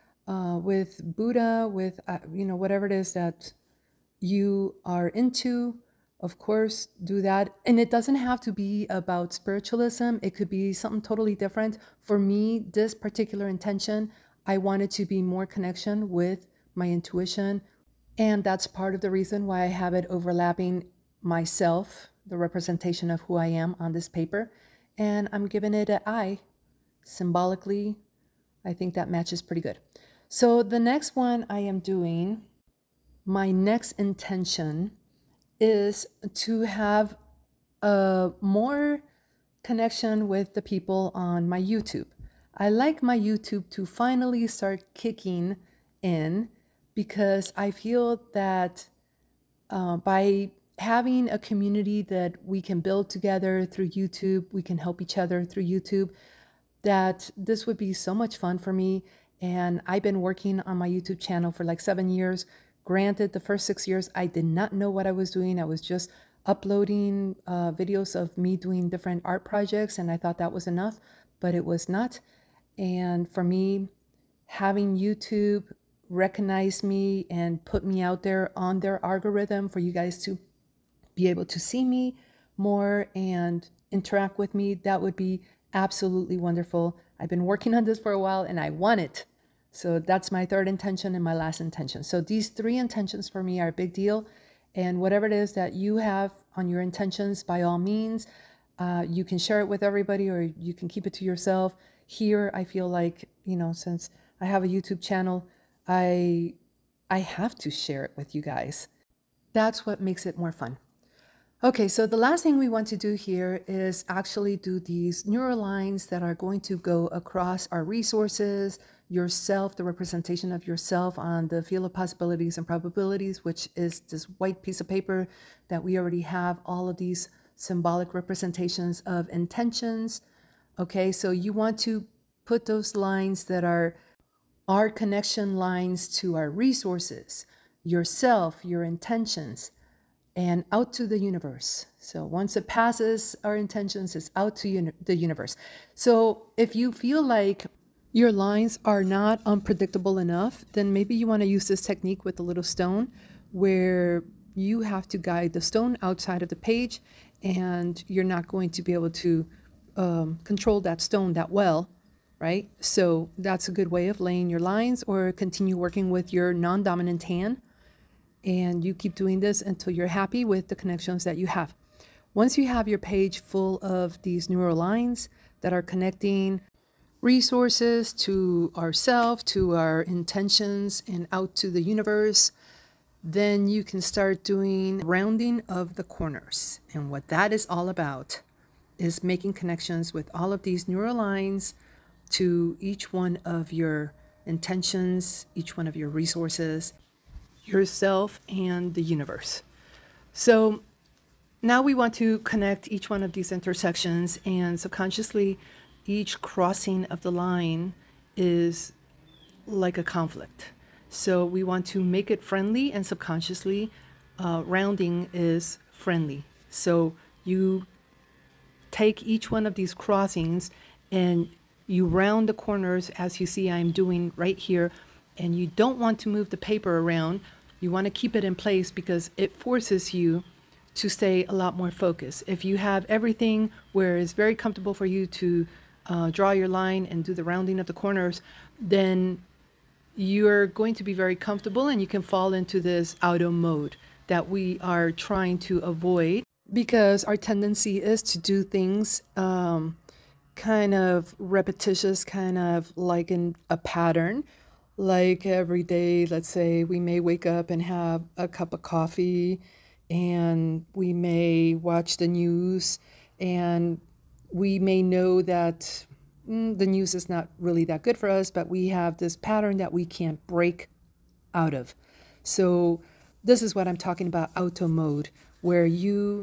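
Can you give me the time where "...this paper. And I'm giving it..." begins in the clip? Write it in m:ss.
0:23.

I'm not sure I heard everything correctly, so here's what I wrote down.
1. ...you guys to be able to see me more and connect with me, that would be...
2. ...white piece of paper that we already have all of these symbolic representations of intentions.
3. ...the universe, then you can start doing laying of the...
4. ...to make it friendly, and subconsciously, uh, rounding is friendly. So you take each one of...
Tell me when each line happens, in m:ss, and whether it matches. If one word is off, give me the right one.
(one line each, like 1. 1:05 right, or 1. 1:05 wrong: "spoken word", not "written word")
1. 1:19 wrong: "interact", not "connect"
2. 2:04 right
3. 3:01 wrong: "rounding", not "laying"
4. 3:31 right.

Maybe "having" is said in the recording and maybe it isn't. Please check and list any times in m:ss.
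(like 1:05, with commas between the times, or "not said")
0:50, 1:14.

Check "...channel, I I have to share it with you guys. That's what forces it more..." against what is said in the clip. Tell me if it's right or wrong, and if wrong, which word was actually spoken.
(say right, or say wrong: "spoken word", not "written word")
wrong: "makes", not "forces".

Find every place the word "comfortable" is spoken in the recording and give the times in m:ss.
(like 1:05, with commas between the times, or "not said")
3:54, 4:01.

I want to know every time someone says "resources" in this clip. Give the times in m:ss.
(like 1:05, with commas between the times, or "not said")
1:57, 2:16, 2:57, 3:16.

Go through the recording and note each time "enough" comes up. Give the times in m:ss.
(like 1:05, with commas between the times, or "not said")
1:10, 2:30.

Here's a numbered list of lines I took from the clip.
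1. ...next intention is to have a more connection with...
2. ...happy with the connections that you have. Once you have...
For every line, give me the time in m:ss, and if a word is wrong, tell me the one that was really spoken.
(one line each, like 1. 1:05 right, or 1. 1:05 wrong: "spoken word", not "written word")
1. 0:33 right
2. 2:50 right.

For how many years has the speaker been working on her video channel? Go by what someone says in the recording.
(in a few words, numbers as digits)
7.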